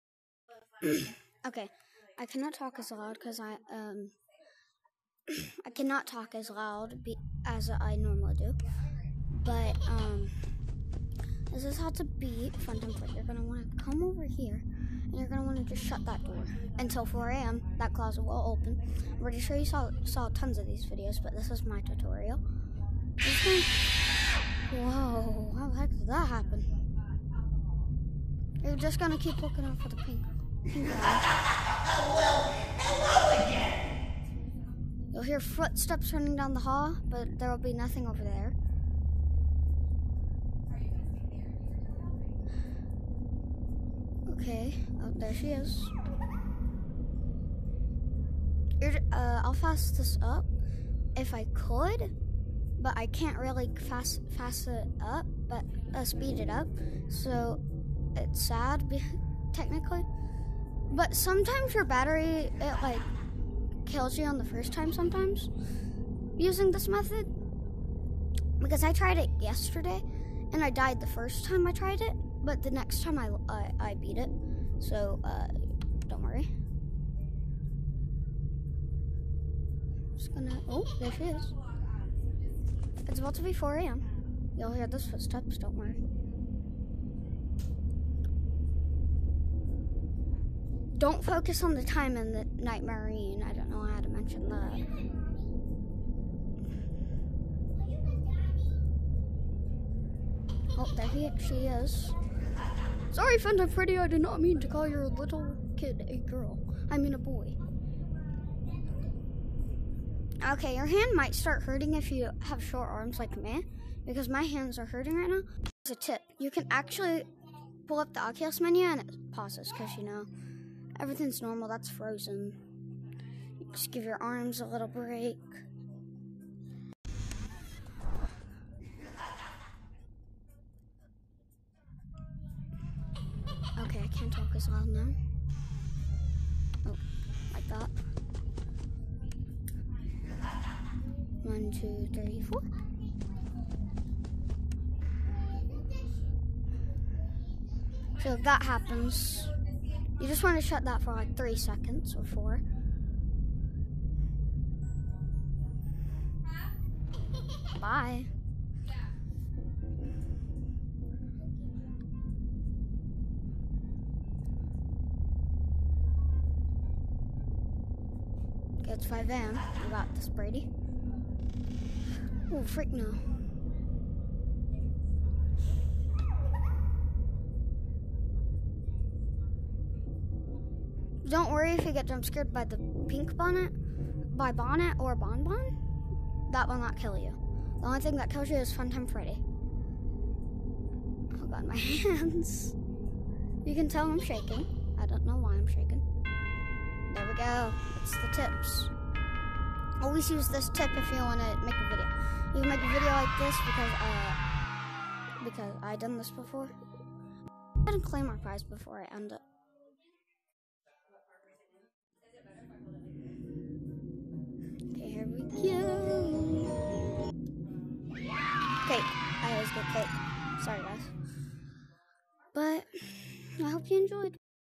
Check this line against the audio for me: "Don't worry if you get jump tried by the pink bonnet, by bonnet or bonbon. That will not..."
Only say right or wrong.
wrong.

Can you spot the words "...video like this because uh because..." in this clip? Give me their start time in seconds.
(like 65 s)
202 s.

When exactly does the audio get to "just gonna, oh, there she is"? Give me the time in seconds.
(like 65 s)
80 s.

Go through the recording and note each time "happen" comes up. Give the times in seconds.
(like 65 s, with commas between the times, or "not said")
26 s, 148 s.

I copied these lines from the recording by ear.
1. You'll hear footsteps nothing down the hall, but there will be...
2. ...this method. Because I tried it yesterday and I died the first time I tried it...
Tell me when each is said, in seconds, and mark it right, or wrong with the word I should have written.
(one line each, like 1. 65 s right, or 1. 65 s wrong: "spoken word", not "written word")
1. 35 s wrong: "running", not "nothing"
2. 66 s right.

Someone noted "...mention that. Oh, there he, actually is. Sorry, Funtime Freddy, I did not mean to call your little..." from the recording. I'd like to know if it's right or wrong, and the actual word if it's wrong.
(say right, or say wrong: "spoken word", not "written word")
right.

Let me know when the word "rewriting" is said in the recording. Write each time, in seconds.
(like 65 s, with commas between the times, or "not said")
not said.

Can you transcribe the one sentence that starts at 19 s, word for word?
I'm pretty sure you saw saw tons of these videos, but this is my tutorial.